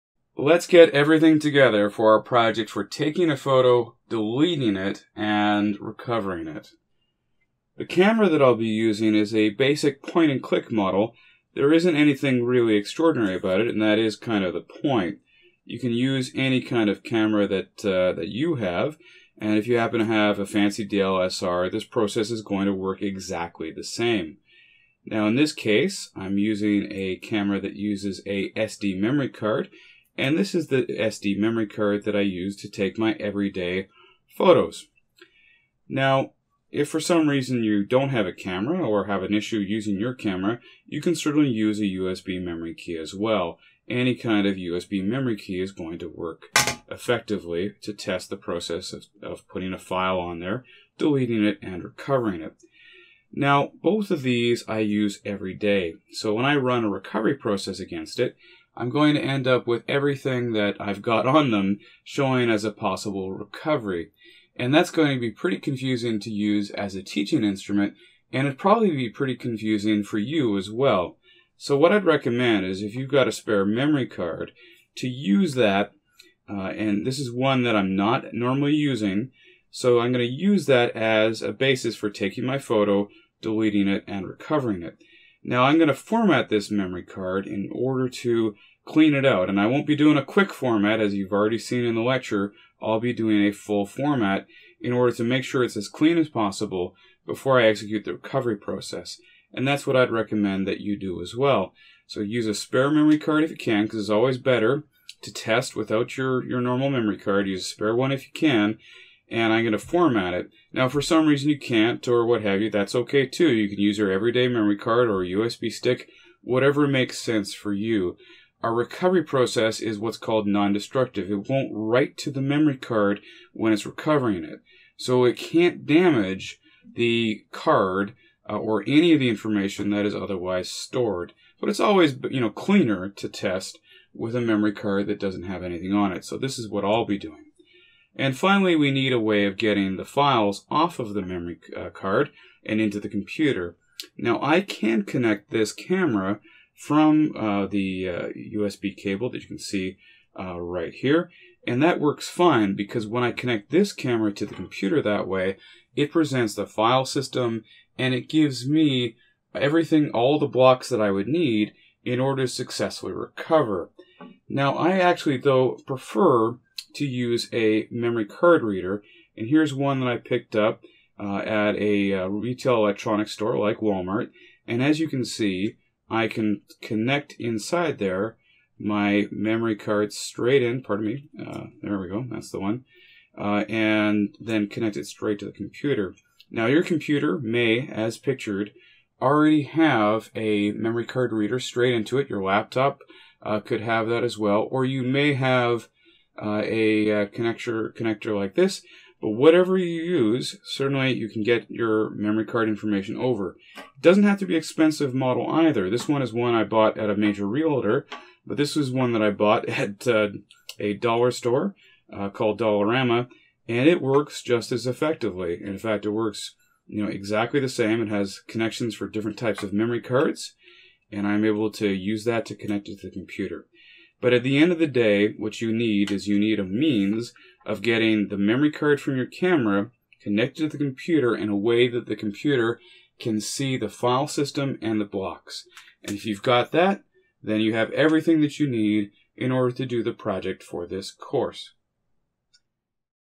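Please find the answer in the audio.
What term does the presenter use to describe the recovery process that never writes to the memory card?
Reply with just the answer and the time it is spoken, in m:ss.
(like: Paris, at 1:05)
Non destructive, at 2:00.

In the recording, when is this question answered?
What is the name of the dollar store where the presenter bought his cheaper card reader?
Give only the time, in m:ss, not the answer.
3:32.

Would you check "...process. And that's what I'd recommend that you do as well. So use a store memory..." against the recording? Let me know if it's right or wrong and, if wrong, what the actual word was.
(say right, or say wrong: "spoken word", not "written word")
wrong: "spare", not "store".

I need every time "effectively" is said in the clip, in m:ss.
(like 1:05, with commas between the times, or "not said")
0:46, 3:34.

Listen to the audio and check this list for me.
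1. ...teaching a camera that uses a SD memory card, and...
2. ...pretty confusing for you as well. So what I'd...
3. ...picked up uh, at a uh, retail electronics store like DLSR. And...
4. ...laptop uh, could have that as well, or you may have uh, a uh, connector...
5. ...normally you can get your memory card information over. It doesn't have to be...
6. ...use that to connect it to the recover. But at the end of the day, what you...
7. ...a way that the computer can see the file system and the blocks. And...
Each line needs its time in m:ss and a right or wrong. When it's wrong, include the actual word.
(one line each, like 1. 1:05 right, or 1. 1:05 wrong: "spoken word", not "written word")
1. 0:26 wrong: "using", not "teaching"
2. 1:09 right
3. 2:50 wrong: "Walmart", not "DLSR"
4. 3:12 right
5. 3:20 wrong: "certainly", not "normally"
6. 3:41 wrong: "computer", not "recover"
7. 3:51 right.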